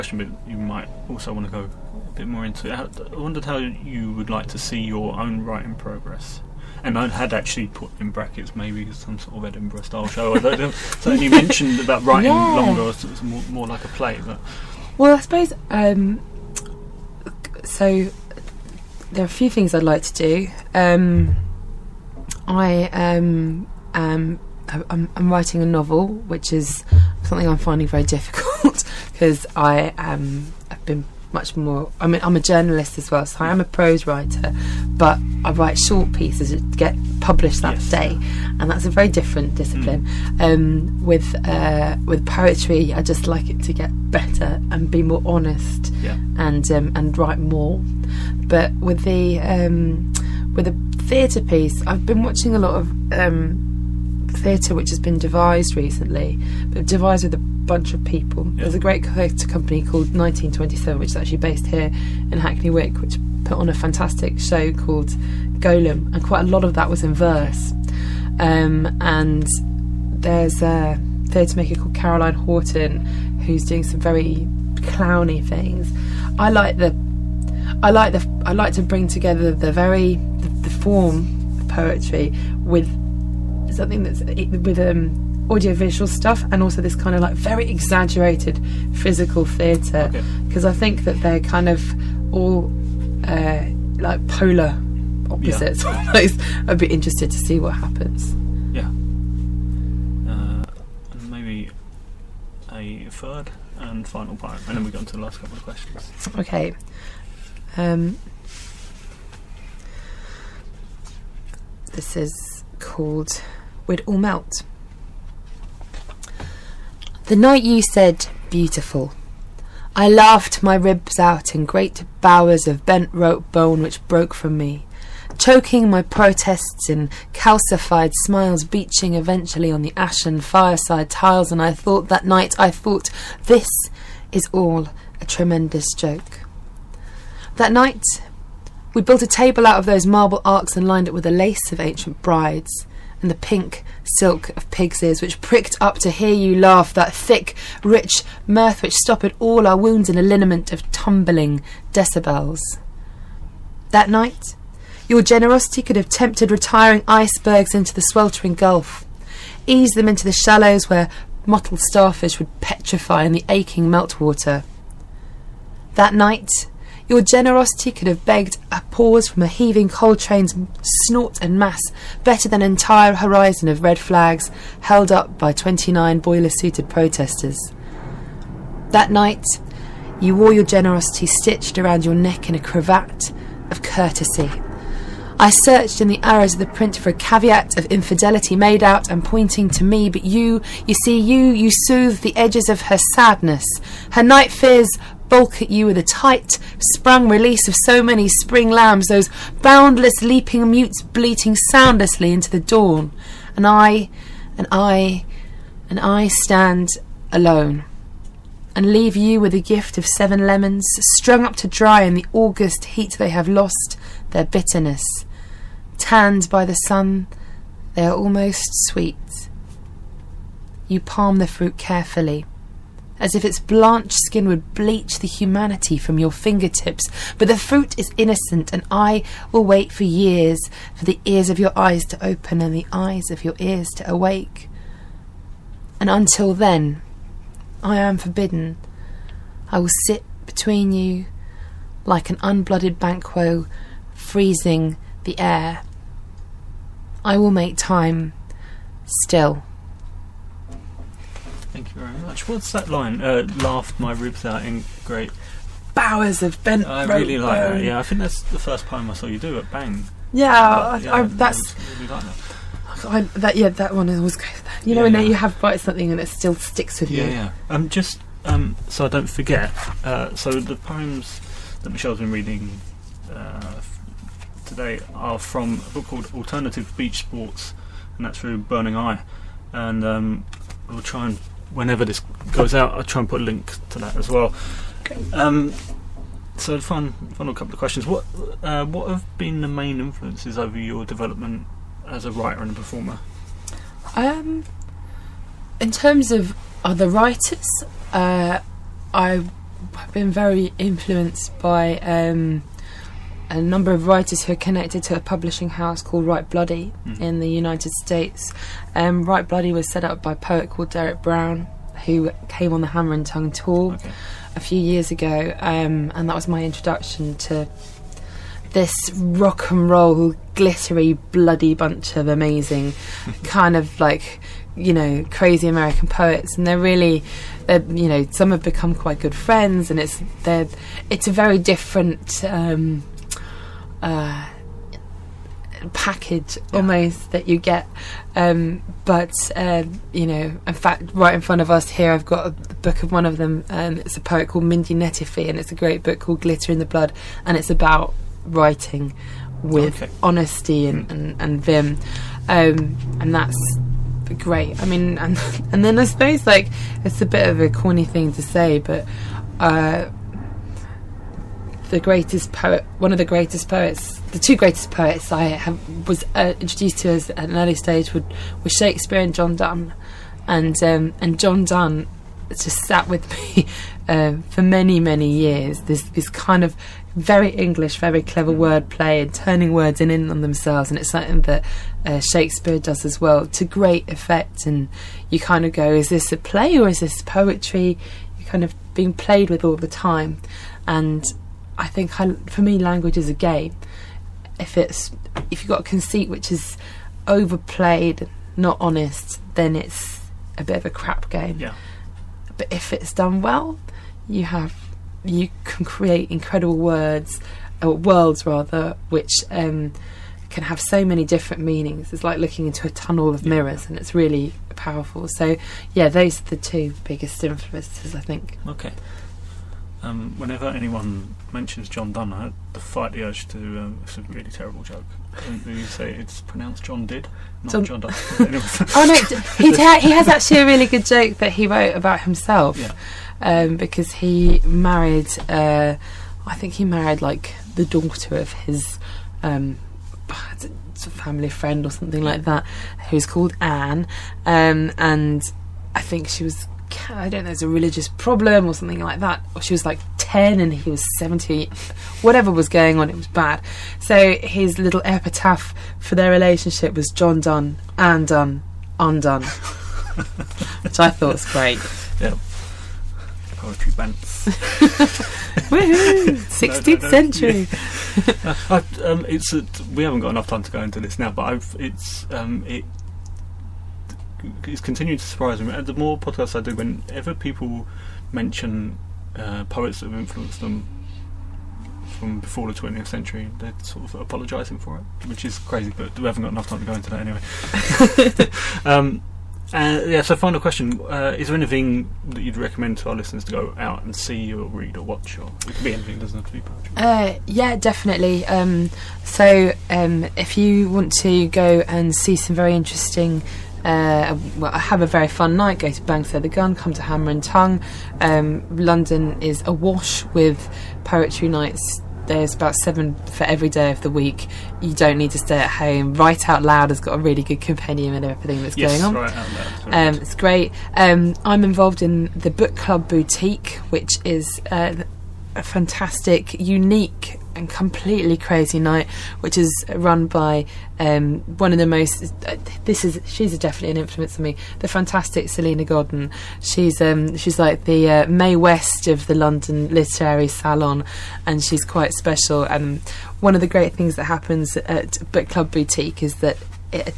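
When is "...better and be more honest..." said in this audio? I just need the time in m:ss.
0:44.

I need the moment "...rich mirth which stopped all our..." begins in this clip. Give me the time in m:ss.
2:27.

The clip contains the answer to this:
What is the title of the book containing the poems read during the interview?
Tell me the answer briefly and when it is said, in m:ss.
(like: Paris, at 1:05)
Alternative Beach Sports, at 4:36.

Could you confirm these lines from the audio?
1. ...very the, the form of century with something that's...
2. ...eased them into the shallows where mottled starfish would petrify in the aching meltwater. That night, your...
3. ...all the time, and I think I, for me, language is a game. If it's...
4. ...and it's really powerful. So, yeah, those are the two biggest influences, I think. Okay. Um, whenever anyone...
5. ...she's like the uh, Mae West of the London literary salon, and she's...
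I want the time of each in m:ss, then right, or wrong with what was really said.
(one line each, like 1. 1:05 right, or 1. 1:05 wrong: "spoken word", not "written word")
1. 1:19 wrong: "poetry", not "century"
2. 2:39 right
3. 6:29 right
4. 6:53 right
5. 8:57 right.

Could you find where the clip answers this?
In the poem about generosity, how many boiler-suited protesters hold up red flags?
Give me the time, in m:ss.
2:55.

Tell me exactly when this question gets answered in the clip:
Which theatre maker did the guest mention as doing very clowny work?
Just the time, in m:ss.
1:11.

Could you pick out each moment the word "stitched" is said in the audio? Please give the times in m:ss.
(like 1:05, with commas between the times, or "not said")
3:01.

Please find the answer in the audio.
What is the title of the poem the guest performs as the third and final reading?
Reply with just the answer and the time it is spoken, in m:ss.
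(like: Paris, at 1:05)
We'd All Melt, at 1:53.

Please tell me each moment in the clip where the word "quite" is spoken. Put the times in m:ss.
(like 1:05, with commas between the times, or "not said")
1:06, 5:28, 9:01.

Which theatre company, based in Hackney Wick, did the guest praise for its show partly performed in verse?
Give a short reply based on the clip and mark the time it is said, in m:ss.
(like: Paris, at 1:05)
1927, at 1:00.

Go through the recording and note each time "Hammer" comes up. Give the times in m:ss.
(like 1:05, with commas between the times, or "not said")
5:12, 8:27.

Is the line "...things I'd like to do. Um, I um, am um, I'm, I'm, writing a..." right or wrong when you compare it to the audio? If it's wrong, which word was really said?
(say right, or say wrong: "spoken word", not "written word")
right.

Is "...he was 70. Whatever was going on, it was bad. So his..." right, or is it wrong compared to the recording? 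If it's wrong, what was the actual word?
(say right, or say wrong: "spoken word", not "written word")
right.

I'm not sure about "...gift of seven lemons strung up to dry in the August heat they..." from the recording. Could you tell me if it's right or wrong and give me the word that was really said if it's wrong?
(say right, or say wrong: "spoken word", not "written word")
right.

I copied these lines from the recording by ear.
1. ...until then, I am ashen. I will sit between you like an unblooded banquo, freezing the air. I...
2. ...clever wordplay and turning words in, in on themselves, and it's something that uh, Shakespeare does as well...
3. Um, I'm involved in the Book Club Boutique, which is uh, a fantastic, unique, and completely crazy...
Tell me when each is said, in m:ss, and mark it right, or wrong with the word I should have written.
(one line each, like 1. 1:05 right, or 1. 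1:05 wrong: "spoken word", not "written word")
1. 3:56 wrong: "forbidden", not "ashen"
2. 6:18 right
3. 8:40 right.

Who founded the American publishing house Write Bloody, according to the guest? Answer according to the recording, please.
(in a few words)
Derek Brown.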